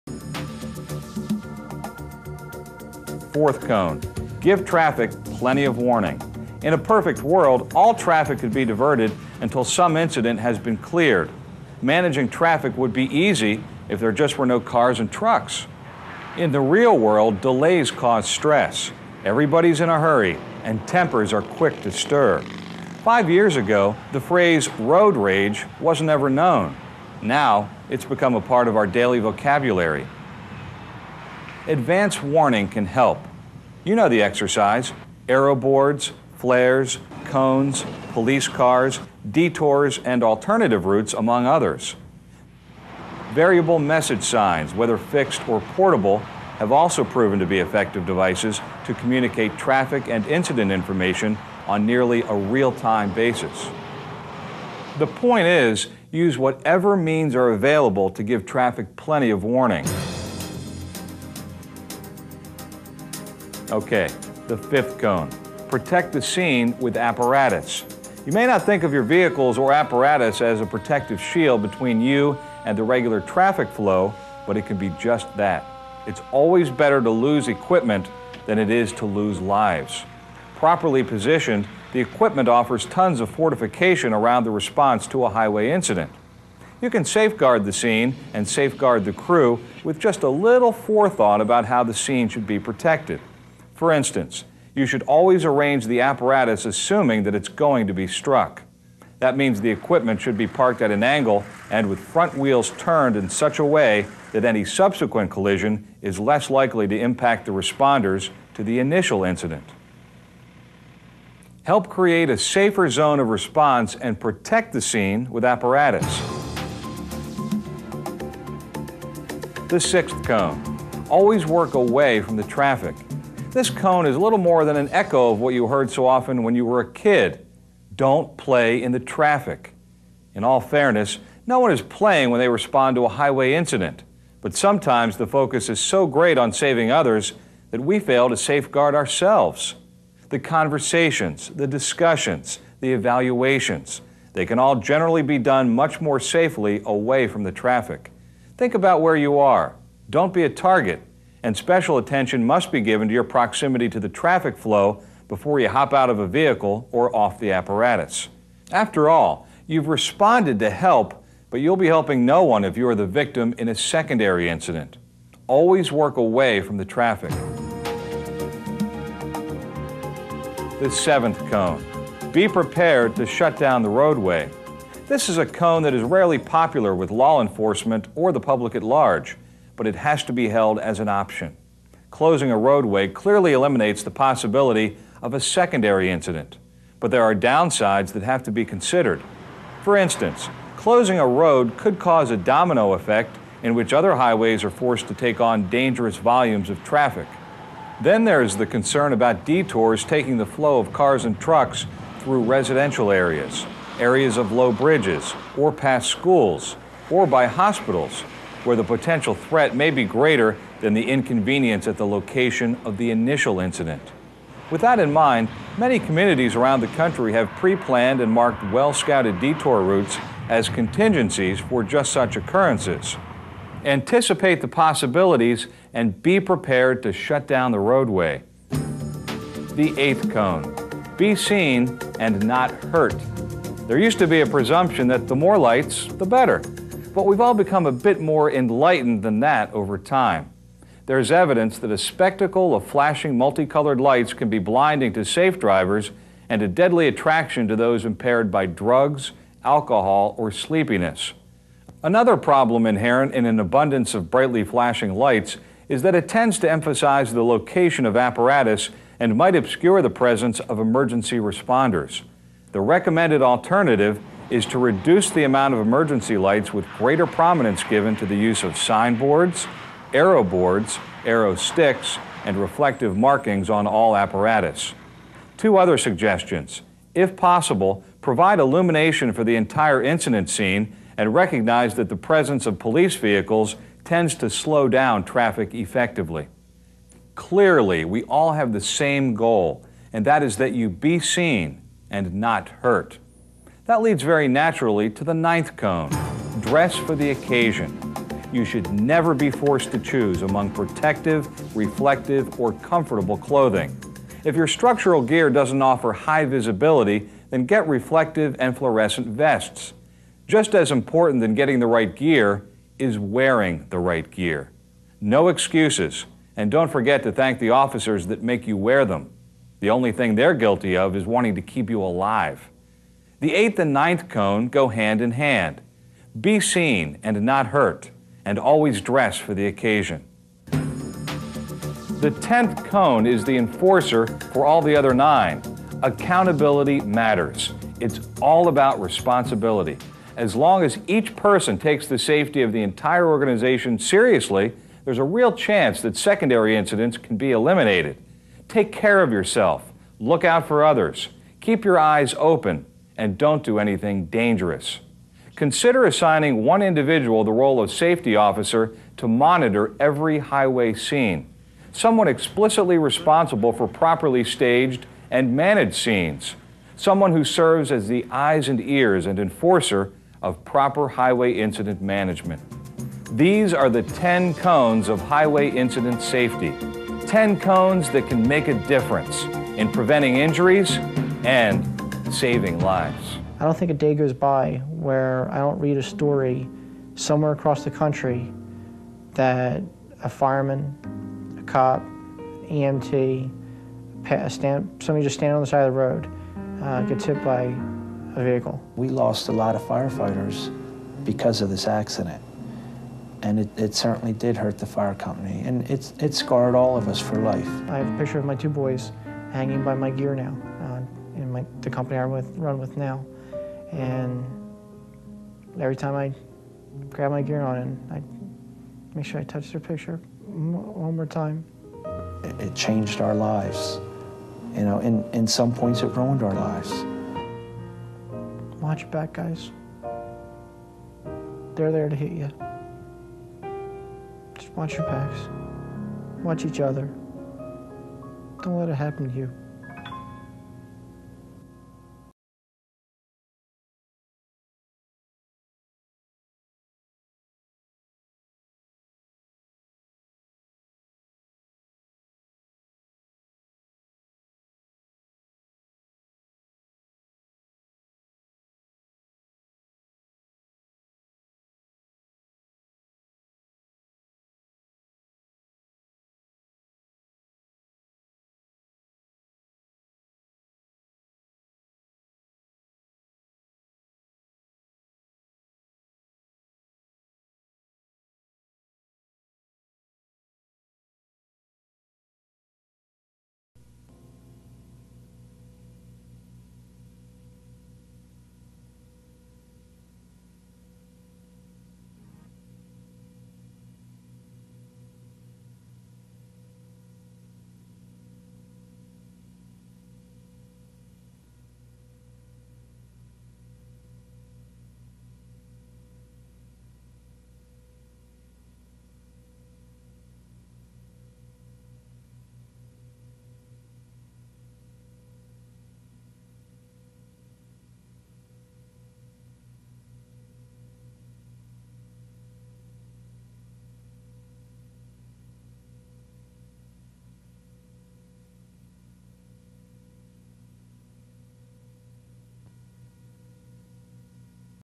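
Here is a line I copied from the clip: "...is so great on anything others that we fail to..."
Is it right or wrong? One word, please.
wrong.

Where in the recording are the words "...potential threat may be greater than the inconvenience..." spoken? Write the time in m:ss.
3:28.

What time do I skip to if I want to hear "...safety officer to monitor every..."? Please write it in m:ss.
5:57.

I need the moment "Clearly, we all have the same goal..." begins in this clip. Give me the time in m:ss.
4:47.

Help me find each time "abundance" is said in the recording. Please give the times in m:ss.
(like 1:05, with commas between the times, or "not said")
4:13.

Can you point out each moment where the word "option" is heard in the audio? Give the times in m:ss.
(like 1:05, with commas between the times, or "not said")
3:01.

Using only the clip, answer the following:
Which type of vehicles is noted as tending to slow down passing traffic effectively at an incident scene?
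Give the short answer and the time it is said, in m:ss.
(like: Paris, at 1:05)
police vehicles, at 4:42.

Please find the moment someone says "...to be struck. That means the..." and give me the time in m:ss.
1:37.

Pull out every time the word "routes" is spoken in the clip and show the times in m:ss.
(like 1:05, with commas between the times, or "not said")
0:40, 3:39.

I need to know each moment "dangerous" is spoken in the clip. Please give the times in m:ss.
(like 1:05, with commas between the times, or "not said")
3:15, 5:54.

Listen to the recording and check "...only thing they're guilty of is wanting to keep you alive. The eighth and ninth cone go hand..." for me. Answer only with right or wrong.
right.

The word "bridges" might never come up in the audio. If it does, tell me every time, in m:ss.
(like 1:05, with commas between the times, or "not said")
3:24.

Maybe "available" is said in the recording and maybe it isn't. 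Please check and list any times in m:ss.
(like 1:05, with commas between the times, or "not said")
0:57.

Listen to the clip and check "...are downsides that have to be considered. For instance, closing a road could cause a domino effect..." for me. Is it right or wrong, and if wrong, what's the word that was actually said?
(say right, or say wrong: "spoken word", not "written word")
right.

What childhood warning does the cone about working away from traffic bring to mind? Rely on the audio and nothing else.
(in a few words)
Don't play in the traffic.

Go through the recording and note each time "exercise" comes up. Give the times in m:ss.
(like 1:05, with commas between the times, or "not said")
0:34.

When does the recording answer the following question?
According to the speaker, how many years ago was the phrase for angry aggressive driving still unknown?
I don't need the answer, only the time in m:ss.
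0:23.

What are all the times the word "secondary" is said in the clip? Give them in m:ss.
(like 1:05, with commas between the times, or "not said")
2:43, 3:05, 5:46.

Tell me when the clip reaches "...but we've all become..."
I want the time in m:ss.
3:57.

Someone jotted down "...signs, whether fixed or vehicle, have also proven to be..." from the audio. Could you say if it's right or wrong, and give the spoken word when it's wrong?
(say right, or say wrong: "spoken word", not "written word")
wrong: "portable", not "vehicle".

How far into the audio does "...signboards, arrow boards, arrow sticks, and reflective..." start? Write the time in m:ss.
4:28.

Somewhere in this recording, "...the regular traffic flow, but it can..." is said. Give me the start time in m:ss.
1:12.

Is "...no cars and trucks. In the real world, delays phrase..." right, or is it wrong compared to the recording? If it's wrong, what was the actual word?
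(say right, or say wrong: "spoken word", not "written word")
wrong: "cause", not "phrase".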